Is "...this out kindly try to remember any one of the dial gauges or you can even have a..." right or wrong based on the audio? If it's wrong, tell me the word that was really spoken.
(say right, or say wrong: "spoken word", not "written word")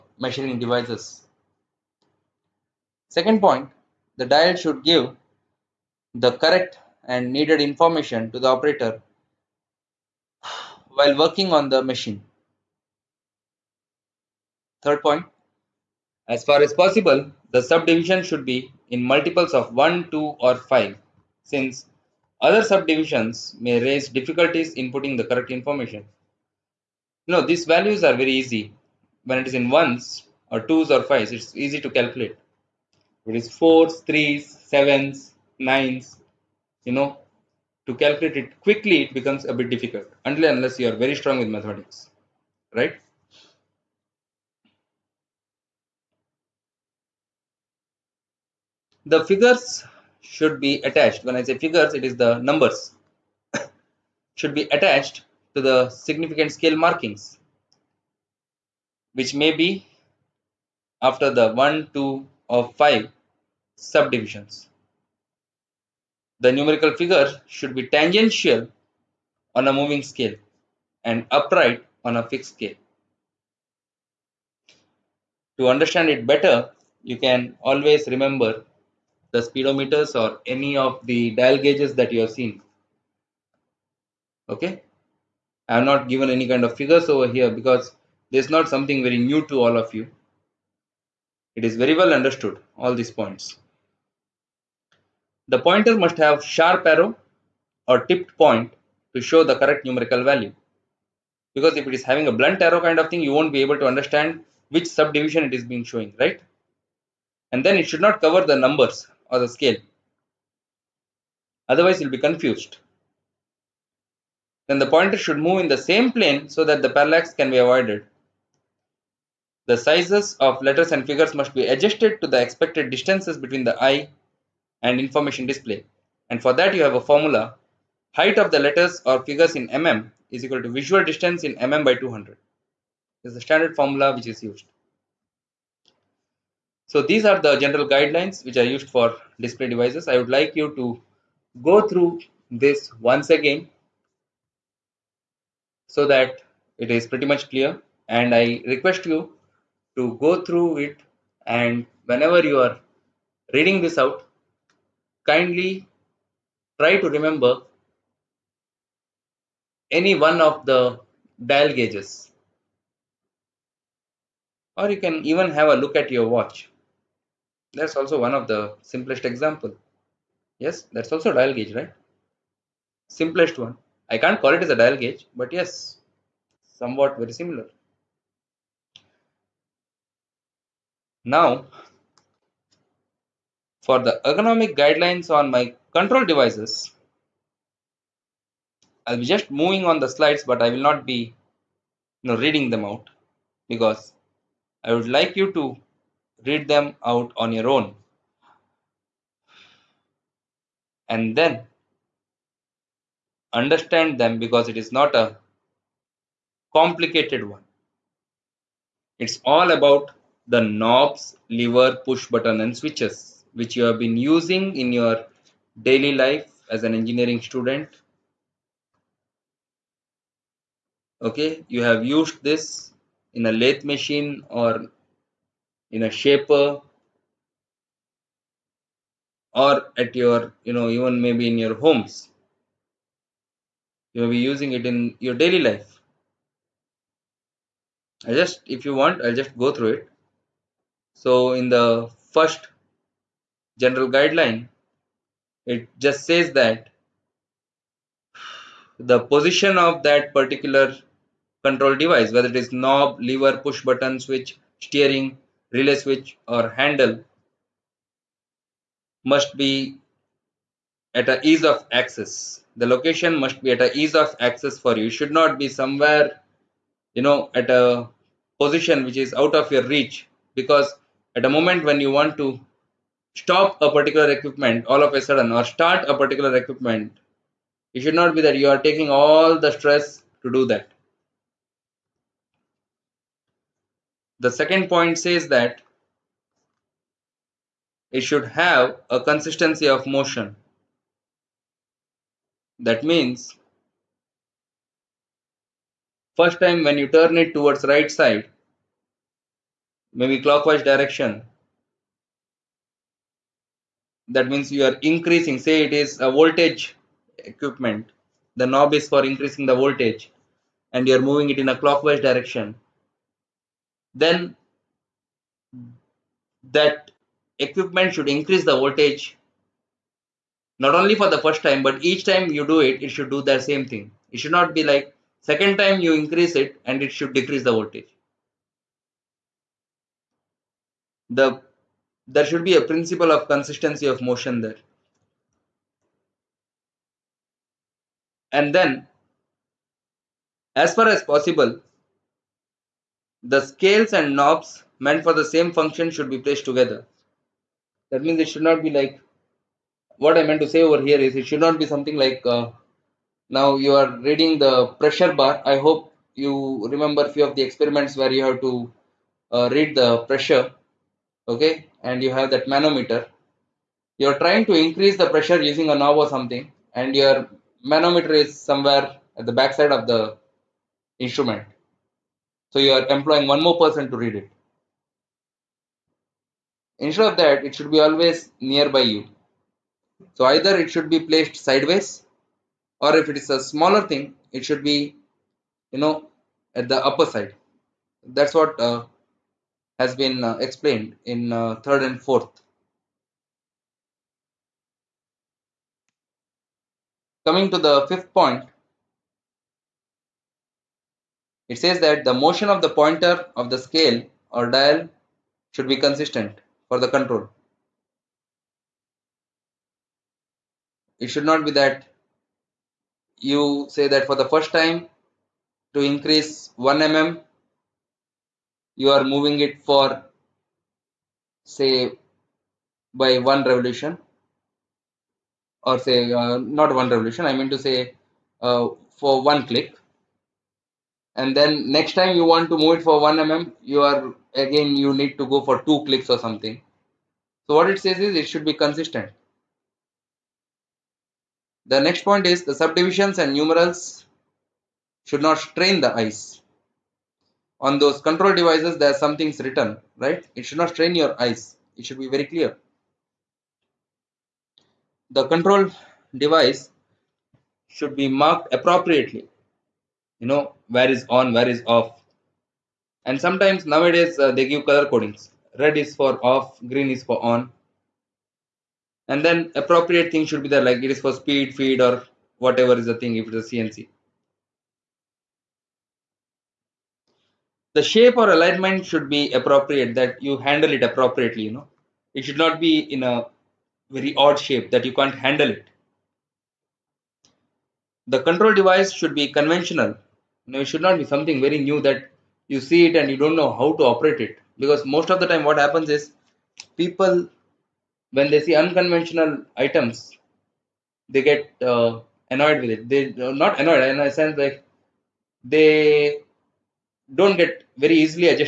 right.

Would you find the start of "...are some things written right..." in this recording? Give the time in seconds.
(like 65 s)
449 s.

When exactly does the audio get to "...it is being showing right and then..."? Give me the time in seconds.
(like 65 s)
105 s.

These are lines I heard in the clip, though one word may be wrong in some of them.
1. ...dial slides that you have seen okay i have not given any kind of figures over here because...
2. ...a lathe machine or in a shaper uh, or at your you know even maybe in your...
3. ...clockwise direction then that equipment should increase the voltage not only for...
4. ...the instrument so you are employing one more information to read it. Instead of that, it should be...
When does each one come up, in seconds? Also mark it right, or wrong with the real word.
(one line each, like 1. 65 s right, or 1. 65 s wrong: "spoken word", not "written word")
1. 81 s wrong: "gauges", not "slides"
2. 223 s right
3. 311 s right
4. 370 s wrong: "person", not "information".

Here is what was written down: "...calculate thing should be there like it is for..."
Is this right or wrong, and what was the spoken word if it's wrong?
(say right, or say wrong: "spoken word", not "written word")
wrong: "appropriate", not "calculate".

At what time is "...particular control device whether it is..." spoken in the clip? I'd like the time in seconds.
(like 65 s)
250 s.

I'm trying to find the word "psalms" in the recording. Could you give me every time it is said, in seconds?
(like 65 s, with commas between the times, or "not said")
not said.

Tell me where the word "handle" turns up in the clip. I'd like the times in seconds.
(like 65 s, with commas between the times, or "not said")
256 s, 480 s, 485 s.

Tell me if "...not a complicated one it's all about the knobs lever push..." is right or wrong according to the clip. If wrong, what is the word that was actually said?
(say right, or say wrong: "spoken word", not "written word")
right.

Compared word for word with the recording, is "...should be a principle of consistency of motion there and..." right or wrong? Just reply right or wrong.
right.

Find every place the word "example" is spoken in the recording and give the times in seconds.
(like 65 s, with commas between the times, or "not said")
169 s.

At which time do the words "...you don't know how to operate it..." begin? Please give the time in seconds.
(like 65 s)
493 s.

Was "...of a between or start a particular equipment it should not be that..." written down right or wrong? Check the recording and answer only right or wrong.
wrong.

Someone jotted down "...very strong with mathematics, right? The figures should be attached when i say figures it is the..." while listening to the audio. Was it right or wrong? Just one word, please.
right.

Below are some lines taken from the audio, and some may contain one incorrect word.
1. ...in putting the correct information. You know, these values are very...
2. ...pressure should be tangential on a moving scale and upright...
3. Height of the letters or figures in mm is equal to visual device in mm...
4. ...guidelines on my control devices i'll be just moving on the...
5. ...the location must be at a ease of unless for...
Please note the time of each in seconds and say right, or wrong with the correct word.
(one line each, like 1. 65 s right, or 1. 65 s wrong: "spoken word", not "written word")
1. 24 s right
2. 67 s wrong: "figure", not "pressure"
3. 128 s wrong: "distance", not "device"
4. 184 s right
5. 262 s wrong: "access", not "unless".